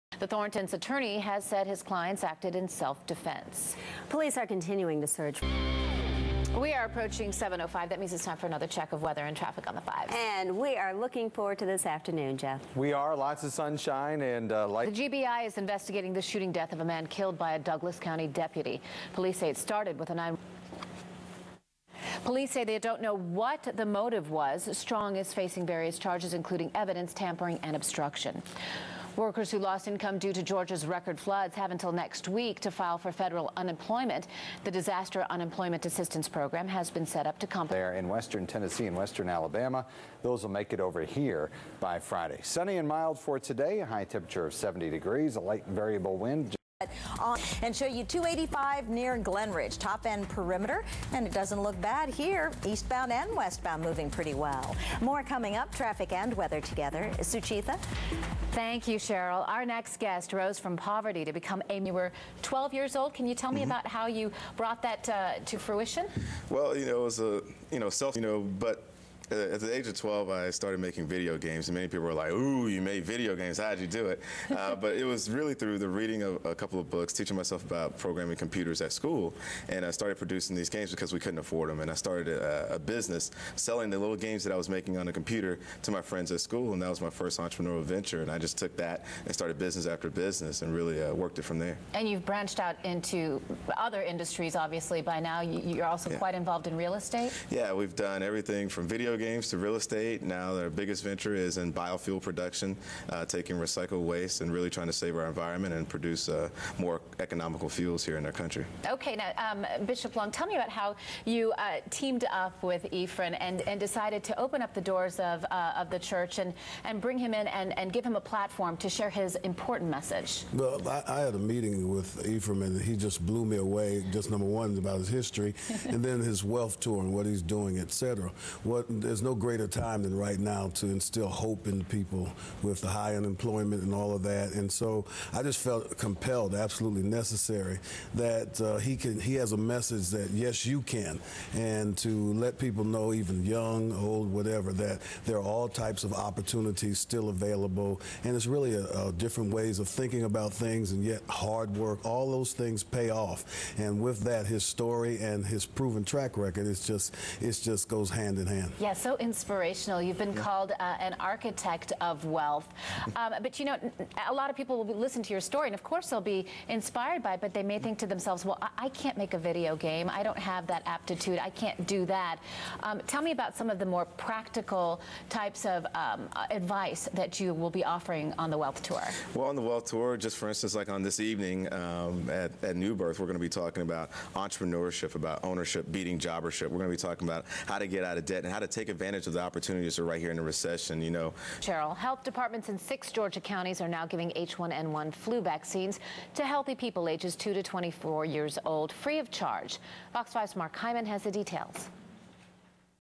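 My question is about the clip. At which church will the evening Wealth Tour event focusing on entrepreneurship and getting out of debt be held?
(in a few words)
New Birth.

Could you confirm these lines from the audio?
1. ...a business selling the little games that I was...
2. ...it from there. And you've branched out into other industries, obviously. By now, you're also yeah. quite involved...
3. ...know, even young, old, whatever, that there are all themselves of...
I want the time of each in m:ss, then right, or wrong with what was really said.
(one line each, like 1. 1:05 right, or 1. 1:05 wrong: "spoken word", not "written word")
1. 1:22 right
2. 1:31 right
3. 2:22 wrong: "types", not "themselves".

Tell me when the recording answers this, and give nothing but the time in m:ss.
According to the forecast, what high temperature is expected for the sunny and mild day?
0:44.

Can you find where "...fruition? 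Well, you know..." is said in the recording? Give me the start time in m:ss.
1:05.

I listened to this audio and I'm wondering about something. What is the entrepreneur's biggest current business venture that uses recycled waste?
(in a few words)
biofuel production.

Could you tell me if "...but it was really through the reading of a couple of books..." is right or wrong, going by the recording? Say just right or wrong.
right.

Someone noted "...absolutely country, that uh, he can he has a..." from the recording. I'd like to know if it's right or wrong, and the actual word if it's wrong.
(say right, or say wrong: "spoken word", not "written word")
wrong: "necessary", not "country".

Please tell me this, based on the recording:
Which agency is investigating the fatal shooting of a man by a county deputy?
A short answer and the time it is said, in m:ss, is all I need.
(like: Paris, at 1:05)
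GBI, at 0:15.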